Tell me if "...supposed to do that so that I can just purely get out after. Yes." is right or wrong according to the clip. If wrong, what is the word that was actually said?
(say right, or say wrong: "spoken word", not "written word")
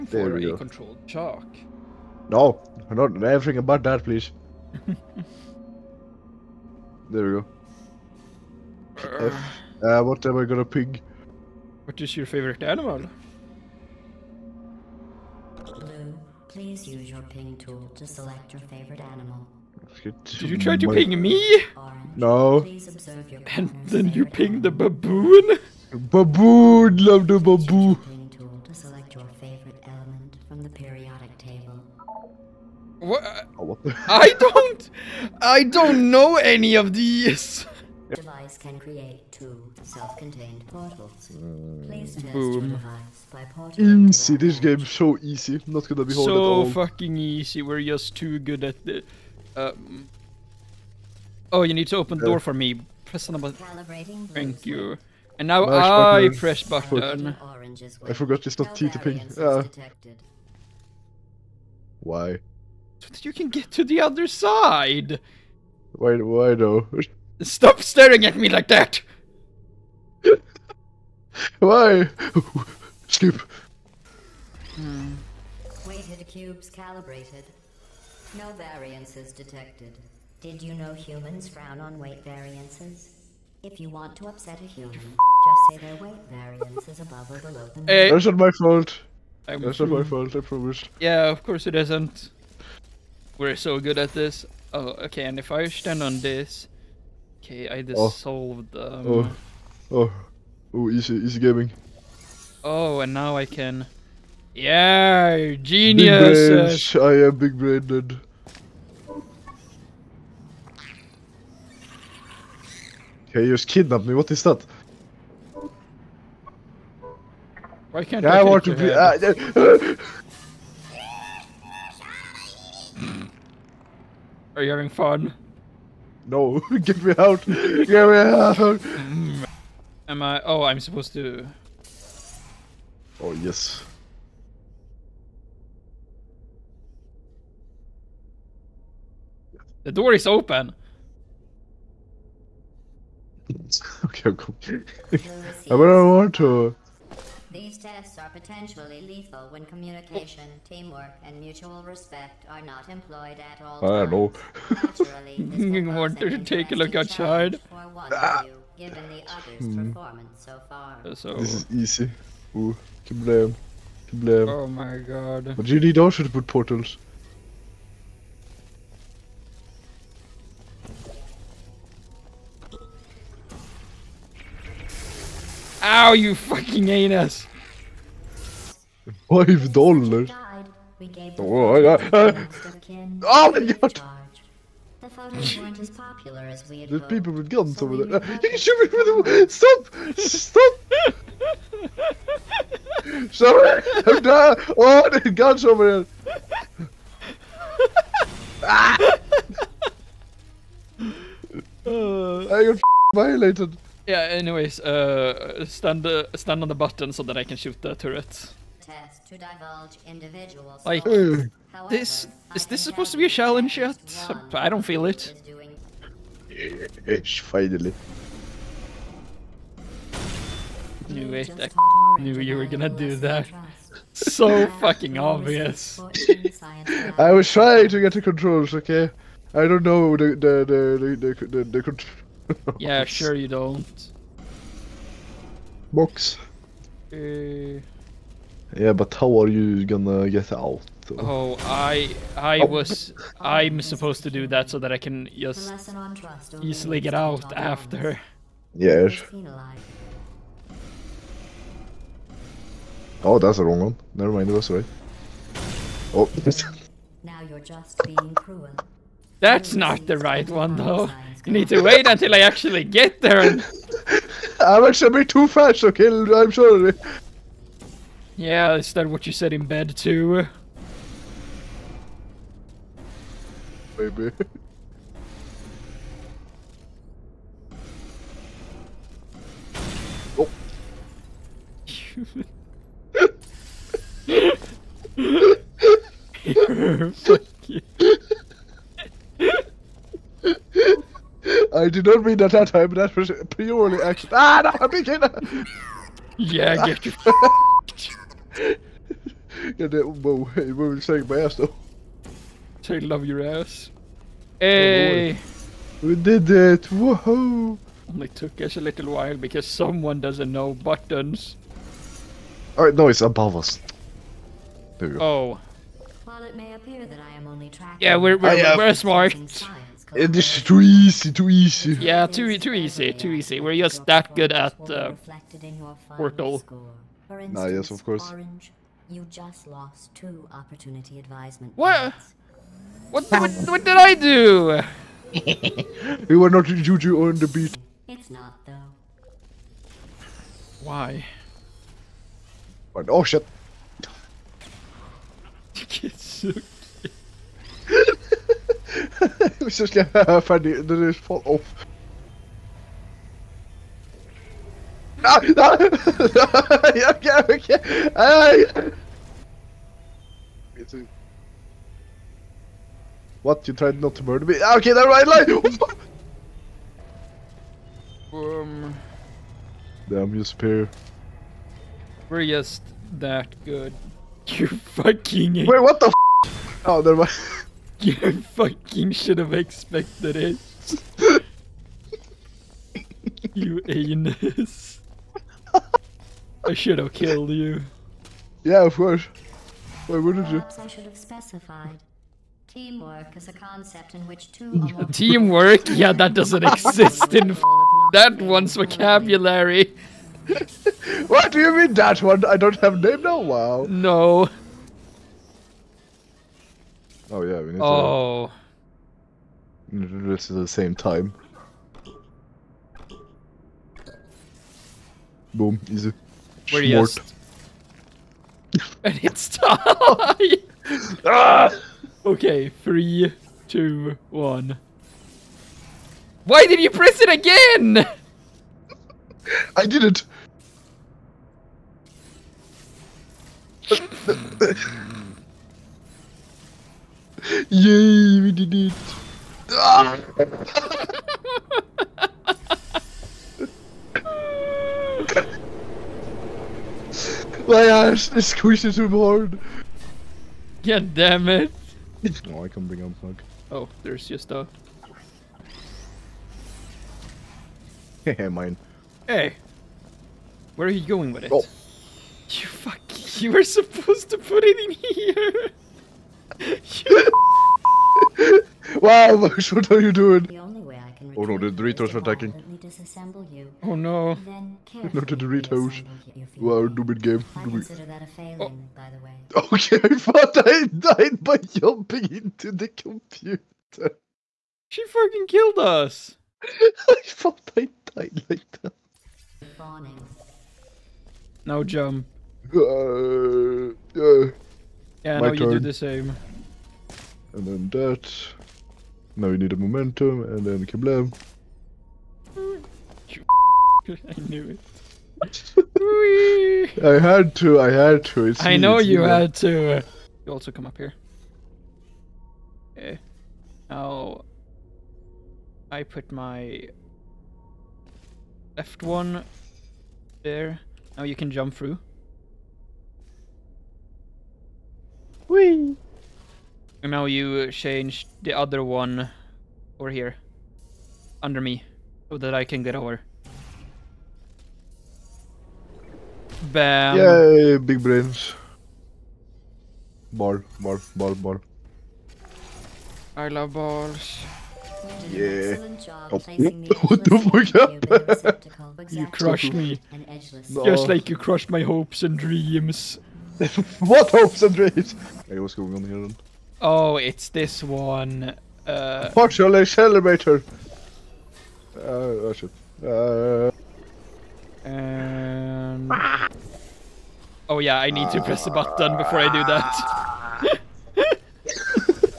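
wrong: "easily", not "purely".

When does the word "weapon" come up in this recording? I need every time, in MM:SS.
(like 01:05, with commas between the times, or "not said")
not said.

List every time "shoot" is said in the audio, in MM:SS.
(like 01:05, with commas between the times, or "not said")
03:08, 03:27.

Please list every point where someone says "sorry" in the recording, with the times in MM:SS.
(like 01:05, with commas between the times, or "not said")
03:13, 04:26.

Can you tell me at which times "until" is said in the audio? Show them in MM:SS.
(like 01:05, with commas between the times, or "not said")
04:22.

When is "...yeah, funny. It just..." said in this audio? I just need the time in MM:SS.
05:49.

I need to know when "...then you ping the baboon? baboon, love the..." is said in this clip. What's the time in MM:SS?
00:23.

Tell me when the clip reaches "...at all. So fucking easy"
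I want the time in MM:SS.
00:46.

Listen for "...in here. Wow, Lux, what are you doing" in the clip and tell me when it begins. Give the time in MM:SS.
07:44.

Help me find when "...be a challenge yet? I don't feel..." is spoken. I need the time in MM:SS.
03:33.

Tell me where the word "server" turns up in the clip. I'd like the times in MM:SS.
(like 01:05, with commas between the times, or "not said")
not said.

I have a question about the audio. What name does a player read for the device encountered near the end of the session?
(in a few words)
Partial accelerator.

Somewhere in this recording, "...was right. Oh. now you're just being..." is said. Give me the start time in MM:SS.
04:14.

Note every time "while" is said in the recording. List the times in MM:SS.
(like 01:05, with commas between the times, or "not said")
05:09, 05:16.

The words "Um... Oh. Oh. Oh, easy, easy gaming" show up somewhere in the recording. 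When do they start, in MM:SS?
01:38.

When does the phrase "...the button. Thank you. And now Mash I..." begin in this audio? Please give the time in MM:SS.
00:53.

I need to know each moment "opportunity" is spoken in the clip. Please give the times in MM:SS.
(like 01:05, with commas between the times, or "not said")
05:30.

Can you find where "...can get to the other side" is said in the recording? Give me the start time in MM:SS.
01:03.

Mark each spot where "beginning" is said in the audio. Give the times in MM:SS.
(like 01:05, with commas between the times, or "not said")
04:54.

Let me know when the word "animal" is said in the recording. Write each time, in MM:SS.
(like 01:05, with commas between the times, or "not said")
00:12, 00:19.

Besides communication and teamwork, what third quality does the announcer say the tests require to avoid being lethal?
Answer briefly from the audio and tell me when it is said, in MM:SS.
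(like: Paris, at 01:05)
Mutual respect, at 02:31.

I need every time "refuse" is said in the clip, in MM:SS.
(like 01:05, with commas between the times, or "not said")
not said.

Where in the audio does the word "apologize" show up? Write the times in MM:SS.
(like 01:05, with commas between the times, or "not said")
not said.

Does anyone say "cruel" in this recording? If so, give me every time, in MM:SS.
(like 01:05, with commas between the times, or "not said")
04:18.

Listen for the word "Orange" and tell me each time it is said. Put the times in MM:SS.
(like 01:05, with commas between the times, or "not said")
00:21, 05:28.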